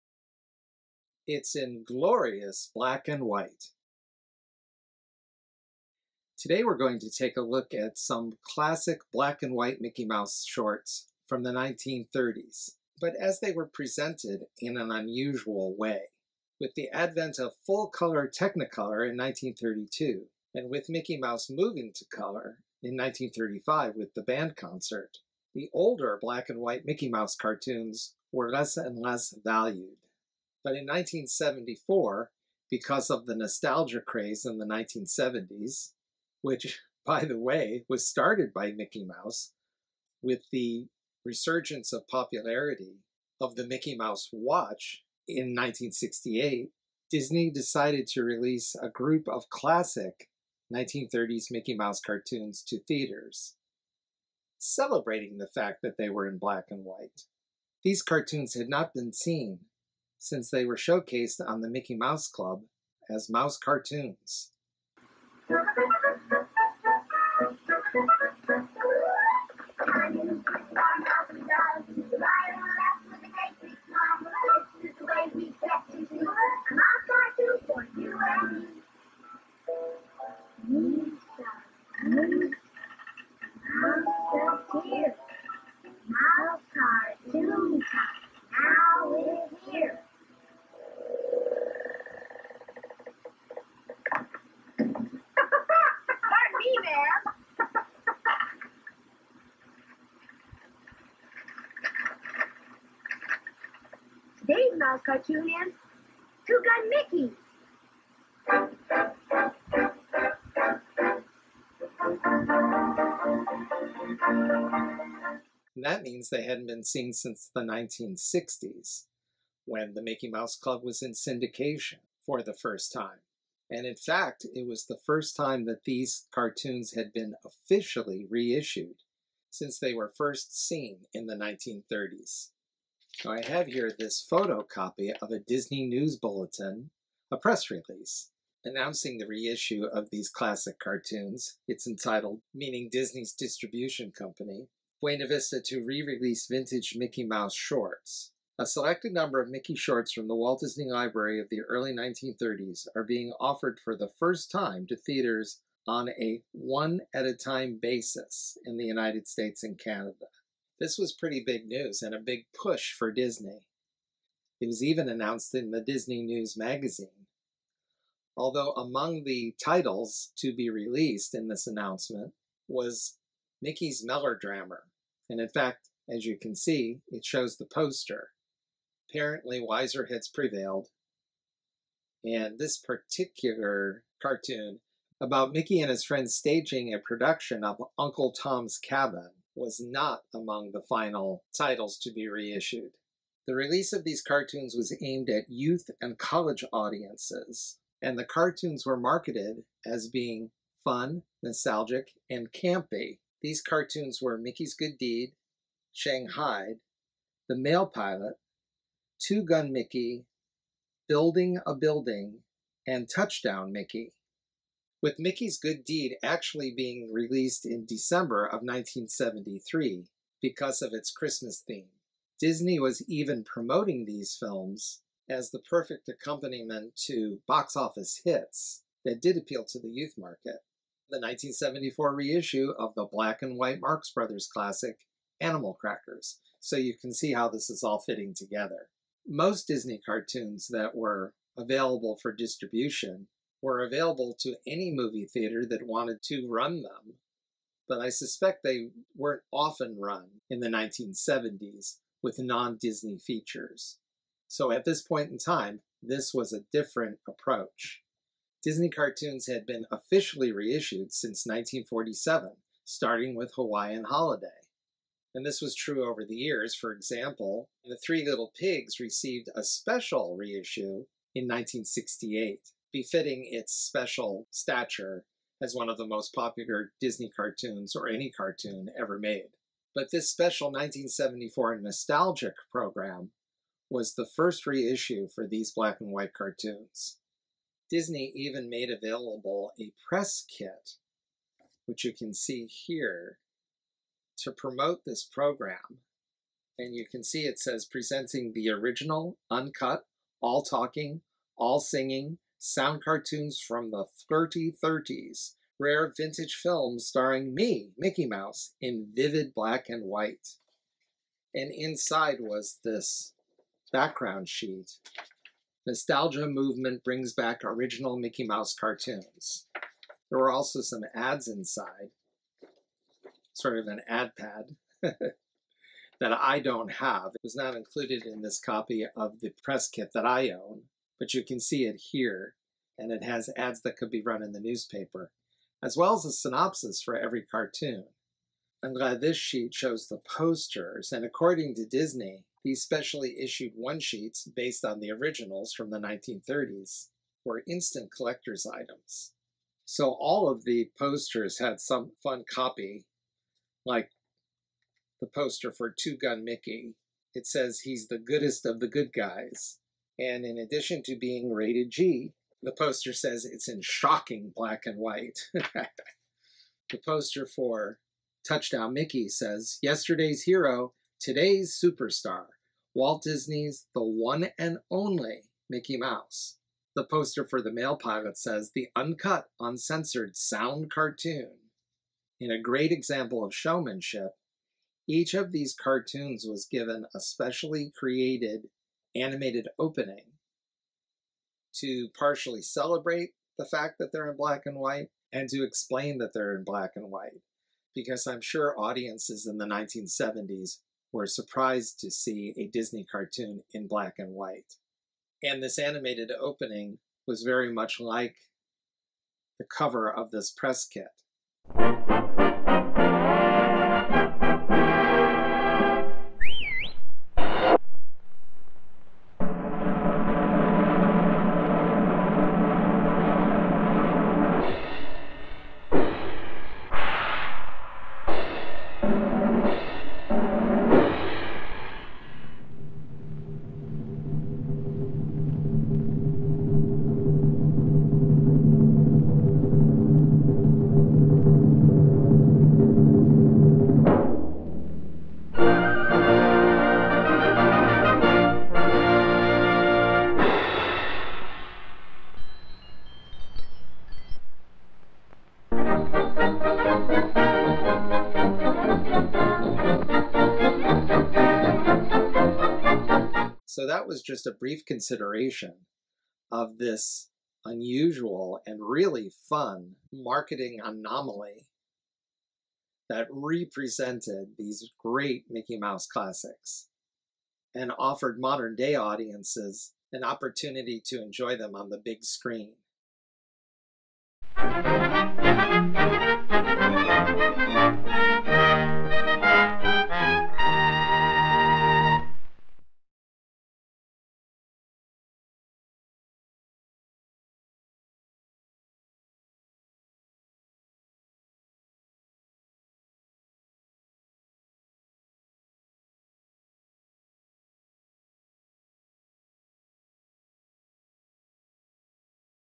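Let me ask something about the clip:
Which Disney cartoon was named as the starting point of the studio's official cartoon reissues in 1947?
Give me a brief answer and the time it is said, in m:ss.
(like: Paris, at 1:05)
Hawaiian Holiday, at 4:23.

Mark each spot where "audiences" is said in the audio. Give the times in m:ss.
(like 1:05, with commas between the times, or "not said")
3:16, 6:38, 7:58.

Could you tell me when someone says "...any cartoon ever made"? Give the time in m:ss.
4:38.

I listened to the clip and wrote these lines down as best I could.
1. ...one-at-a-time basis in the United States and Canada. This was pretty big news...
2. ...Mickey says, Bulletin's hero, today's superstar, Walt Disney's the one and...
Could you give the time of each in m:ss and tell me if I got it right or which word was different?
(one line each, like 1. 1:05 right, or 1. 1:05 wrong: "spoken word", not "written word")
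1. 2:36 right
2. 6:08 wrong: "Yesterday", not "Bulletin".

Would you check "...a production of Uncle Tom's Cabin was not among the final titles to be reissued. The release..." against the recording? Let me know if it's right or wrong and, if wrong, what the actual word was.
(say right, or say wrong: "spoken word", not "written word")
right.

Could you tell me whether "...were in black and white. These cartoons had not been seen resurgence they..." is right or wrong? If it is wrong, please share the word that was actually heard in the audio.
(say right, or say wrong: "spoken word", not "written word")
wrong: "since", not "resurgence".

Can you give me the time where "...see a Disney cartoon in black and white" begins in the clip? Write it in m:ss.
6:42.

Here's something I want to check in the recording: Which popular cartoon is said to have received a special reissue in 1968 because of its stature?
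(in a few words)
The Three Little Pigs.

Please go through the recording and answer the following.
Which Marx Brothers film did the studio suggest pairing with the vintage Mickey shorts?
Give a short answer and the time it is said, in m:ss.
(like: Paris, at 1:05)
Animal Crackers, at 3:55.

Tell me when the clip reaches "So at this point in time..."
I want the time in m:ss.
4:14.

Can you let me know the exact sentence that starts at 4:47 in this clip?
Disney even made available a press kit, which you can see here, to promote this program.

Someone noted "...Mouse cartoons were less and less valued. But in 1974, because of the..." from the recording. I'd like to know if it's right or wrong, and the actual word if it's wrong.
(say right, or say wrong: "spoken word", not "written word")
right.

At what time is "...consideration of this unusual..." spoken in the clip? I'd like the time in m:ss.
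7:44.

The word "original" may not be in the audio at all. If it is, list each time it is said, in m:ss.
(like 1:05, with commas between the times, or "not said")
4:58, 5:17, 5:45.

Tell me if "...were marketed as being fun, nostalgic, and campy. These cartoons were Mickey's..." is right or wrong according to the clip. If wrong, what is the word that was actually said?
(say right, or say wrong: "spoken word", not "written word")
right.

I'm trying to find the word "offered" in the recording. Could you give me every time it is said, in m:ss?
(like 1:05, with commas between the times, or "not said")
2:33, 7:57.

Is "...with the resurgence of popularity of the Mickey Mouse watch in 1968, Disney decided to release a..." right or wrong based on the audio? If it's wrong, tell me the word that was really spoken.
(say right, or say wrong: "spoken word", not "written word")
right.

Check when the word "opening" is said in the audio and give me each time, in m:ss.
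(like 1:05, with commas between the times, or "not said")
6:29, 6:46.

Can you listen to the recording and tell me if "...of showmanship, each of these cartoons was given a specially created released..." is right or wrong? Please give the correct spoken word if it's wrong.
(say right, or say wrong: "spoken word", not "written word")
wrong: "animated", not "released".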